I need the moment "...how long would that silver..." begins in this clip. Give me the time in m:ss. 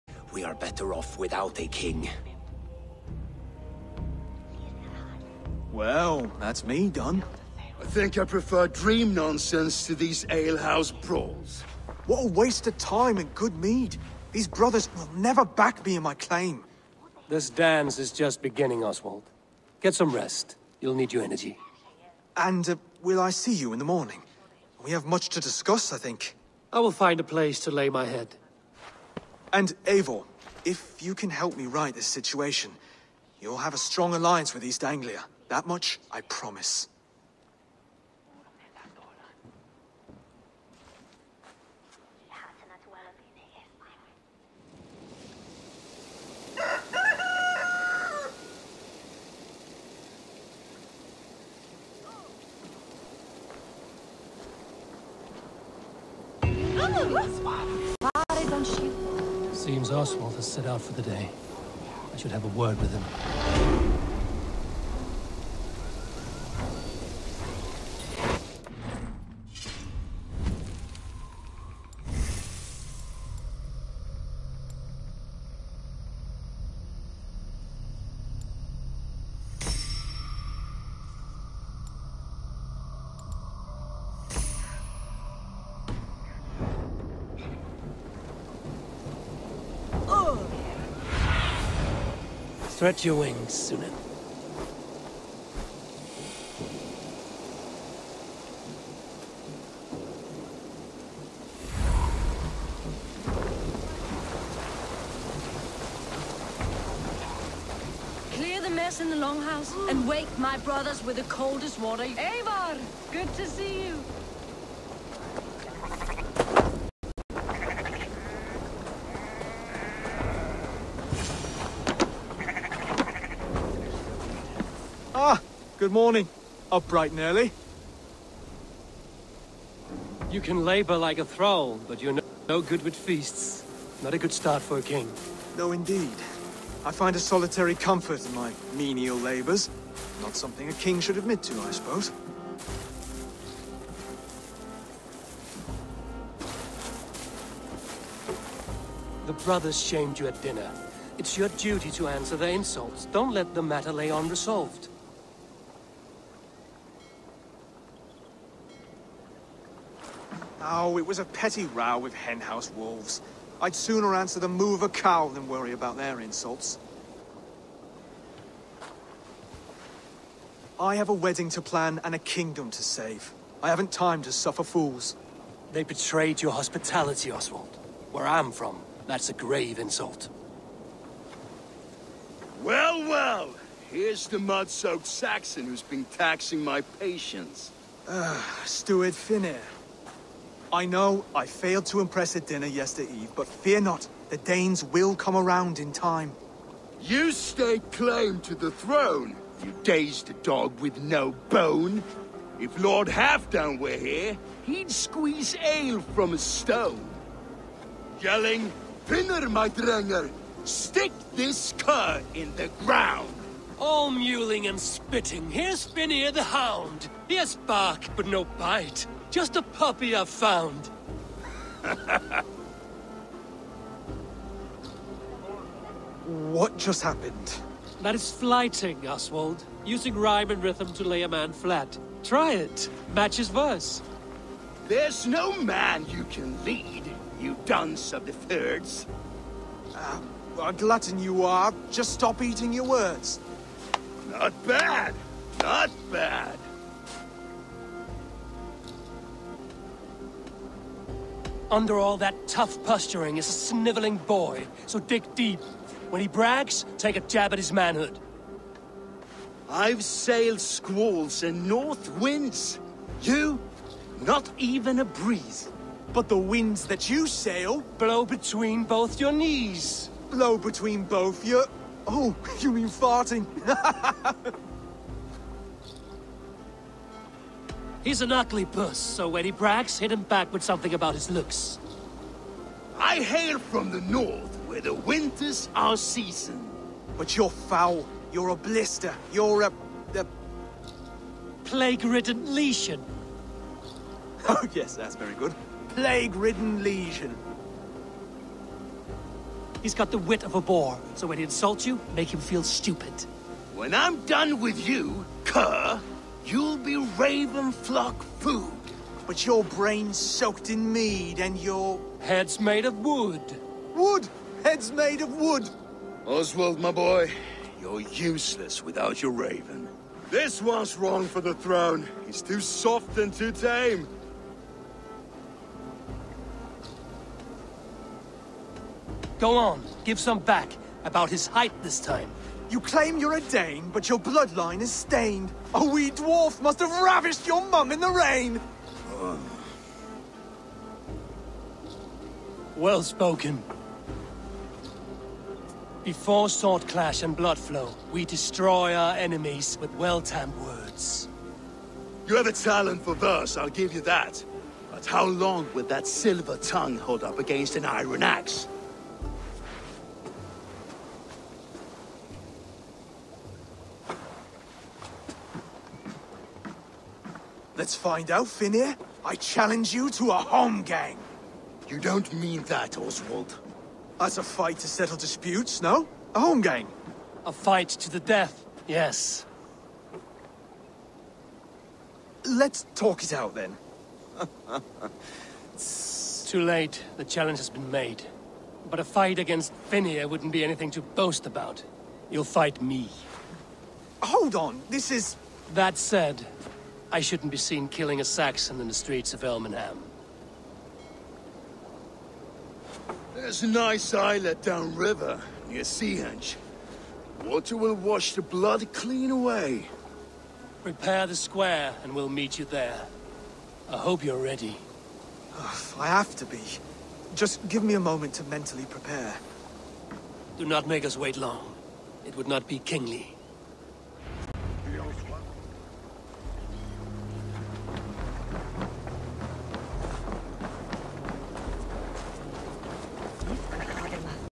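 5:55.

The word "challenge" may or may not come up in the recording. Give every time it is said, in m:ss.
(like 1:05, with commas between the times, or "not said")
6:09, 6:27.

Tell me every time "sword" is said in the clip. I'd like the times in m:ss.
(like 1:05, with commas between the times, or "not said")
5:46.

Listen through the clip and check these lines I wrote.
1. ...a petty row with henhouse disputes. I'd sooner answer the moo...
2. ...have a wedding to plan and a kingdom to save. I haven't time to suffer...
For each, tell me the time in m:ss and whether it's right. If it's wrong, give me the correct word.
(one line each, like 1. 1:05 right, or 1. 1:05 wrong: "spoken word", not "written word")
1. 2:41 wrong: "wolves", not "disputes"
2. 2:50 right.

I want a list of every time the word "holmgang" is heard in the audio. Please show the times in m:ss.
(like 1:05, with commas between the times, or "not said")
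6:10, 6:16.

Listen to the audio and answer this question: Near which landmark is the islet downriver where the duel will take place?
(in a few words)
Seahenge.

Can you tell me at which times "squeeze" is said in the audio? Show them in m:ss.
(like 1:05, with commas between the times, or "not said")
3:24.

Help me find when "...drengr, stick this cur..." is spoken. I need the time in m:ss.
3:29.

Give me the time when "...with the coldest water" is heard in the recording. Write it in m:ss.
1:51.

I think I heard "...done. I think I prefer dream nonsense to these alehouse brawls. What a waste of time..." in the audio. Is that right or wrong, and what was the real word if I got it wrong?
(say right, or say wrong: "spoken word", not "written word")
right.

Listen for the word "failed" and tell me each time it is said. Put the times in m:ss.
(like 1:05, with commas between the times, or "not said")
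3:11.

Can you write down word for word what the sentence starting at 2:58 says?
Where I'm from, that's a grave insult.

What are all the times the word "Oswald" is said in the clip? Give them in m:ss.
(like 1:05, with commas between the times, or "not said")
0:18, 0:59, 2:57, 3:49, 5:16, 6:12.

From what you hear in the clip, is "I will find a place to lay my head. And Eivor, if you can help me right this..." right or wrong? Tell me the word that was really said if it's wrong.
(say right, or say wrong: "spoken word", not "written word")
right.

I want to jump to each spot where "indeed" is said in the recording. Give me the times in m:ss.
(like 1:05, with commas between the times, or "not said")
2:15.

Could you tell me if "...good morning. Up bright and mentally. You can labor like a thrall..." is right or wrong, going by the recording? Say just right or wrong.
wrong.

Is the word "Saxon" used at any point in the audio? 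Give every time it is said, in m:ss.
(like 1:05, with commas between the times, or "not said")
3:05, 6:38.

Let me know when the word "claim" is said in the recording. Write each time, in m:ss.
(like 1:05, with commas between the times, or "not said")
0:16, 3:17, 5:32.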